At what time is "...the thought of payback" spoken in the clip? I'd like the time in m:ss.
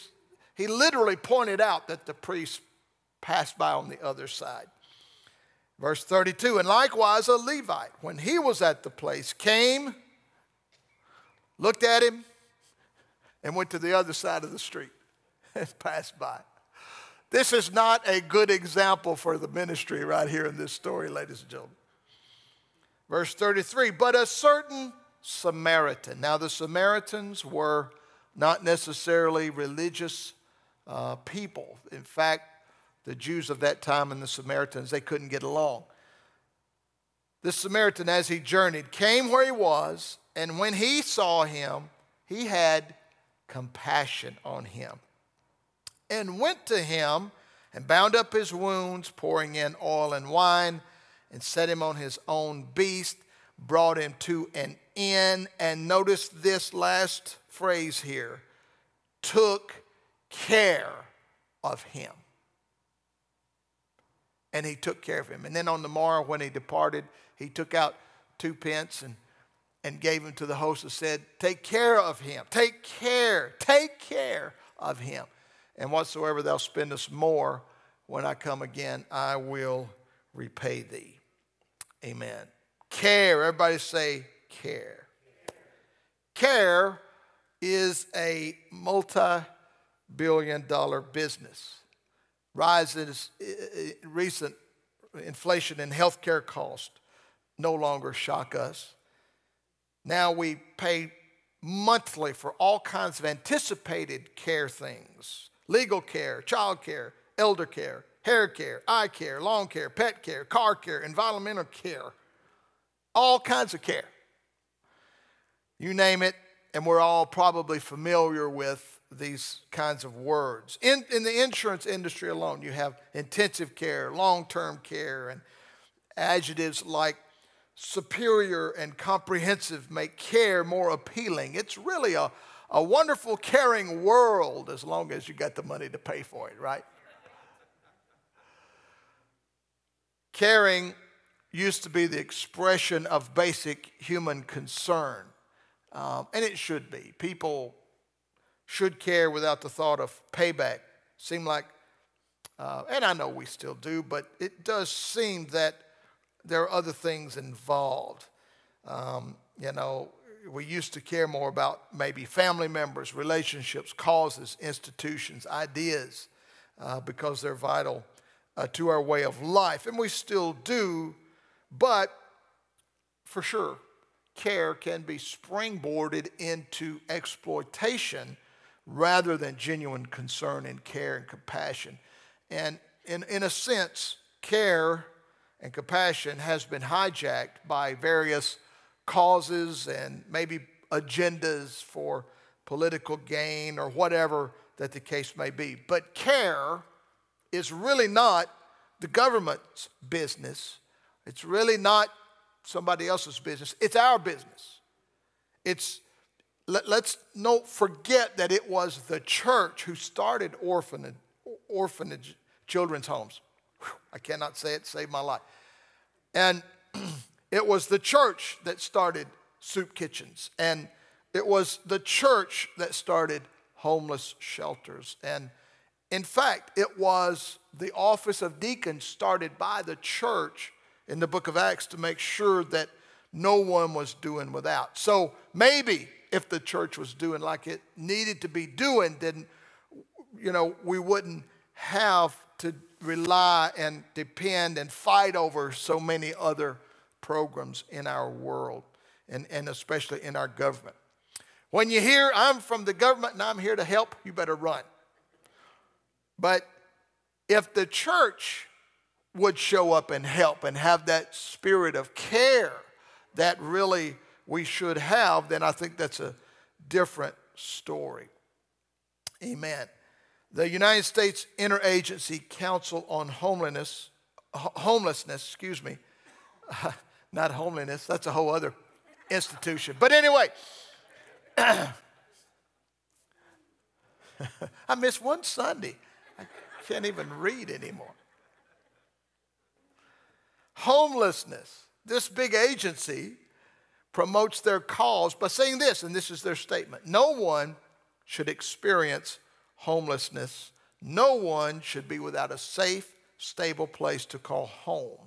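2:29.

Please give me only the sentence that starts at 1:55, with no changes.
You name it, and we're all probably familiar with these kinds of words.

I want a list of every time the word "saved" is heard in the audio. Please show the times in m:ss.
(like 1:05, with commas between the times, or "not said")
3:34.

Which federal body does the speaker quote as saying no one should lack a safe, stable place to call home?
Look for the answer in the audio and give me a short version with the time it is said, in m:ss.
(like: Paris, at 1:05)
United States Interagency Council on Homelessness, at 4:30.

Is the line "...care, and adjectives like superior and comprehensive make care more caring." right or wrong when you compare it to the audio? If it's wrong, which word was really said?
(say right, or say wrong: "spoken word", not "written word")
wrong: "appealing", not "caring".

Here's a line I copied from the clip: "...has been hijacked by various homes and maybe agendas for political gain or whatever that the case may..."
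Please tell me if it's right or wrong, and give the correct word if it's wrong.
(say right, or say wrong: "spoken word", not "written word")
wrong: "causes", not "homes".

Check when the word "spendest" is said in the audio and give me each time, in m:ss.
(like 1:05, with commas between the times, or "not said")
1:16.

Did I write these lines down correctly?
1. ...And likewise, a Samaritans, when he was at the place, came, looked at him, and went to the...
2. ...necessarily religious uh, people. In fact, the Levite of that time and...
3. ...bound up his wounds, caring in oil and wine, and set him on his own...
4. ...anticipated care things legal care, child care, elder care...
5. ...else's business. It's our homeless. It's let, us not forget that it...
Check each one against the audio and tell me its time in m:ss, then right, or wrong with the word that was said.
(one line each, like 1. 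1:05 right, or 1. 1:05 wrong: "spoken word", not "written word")
1. 0:06 wrong: "Levite", not "Samaritans"
2. 0:28 wrong: "Jews", not "Levite"
3. 0:47 wrong: "pouring", not "caring"
4. 1:43 right
5. 3:23 wrong: "business", not "homeless".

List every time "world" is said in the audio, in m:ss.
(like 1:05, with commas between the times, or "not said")
2:14, 4:08.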